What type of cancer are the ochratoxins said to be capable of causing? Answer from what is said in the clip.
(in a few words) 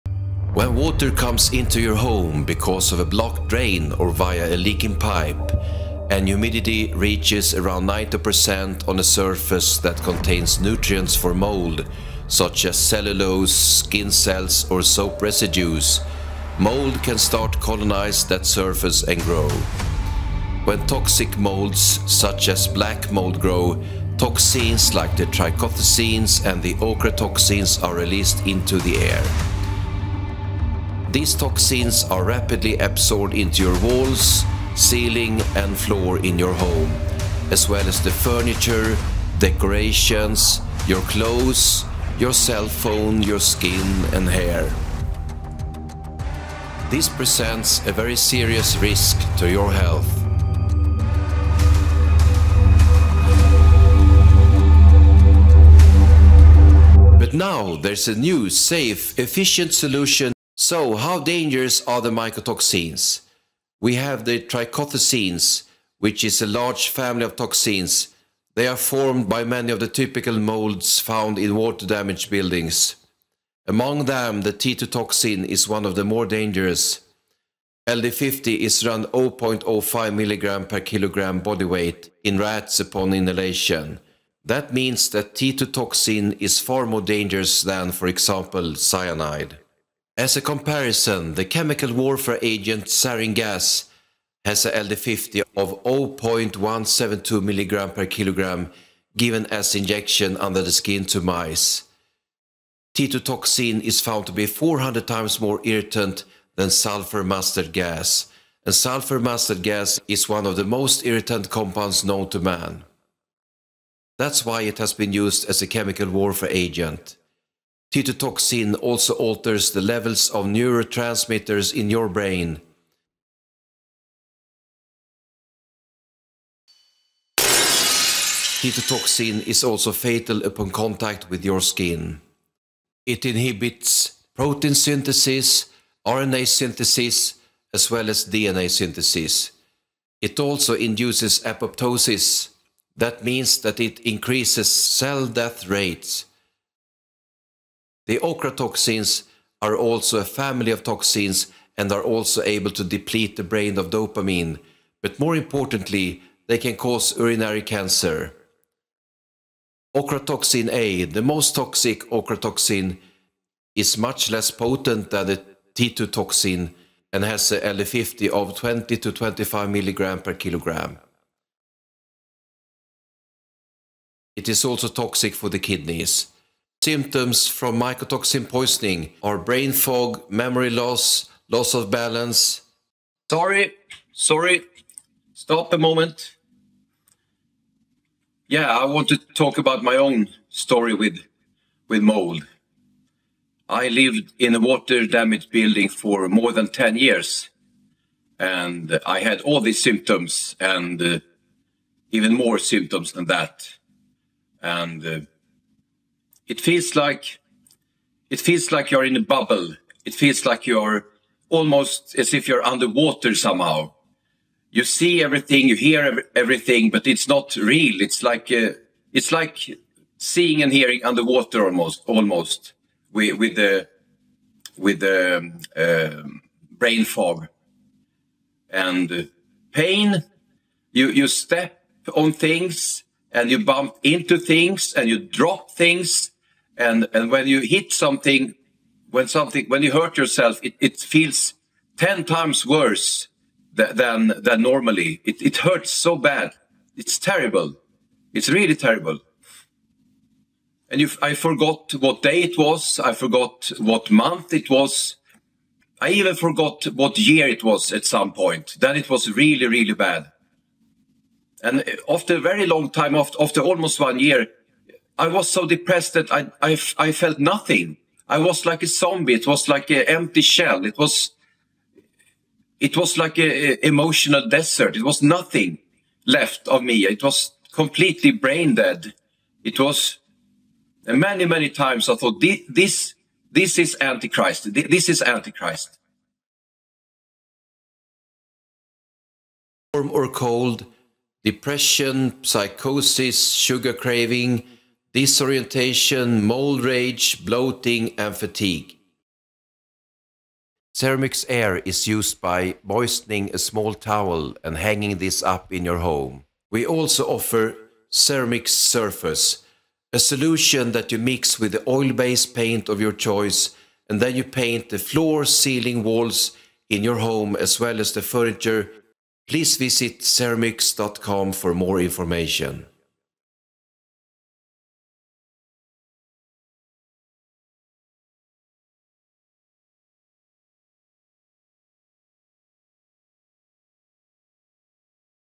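Urinary cancer.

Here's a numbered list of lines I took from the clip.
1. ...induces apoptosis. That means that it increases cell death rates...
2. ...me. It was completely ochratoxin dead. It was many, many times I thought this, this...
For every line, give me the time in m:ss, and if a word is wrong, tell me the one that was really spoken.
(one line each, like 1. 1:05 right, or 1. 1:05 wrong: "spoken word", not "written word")
1. 2:20 right
2. 4:36 wrong: "brain", not "ochratoxin".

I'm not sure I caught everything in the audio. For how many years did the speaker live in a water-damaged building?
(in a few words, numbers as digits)
More than 10 years.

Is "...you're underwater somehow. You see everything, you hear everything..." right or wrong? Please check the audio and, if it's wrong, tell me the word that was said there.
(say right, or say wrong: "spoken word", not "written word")
right.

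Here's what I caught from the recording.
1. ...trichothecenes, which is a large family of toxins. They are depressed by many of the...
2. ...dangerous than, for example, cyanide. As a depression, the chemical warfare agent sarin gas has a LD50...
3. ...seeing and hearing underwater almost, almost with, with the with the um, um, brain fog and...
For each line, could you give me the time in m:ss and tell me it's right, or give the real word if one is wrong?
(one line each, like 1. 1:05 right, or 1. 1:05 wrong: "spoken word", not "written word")
1. 1:04 wrong: "formed", not "depressed"
2. 1:27 wrong: "comparison", not "depression"
3. 3:40 right.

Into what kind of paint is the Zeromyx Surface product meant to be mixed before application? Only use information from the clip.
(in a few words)
Oil-based paint.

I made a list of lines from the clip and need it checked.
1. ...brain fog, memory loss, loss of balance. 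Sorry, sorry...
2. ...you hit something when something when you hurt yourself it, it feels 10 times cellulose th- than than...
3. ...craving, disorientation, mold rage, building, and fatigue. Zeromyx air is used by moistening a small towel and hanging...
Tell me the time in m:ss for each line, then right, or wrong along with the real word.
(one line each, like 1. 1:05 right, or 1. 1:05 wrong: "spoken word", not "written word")
1. 2:59 right
2. 3:57 wrong: "worse", not "cellulose"
3. 4:53 wrong: "bloating", not "building".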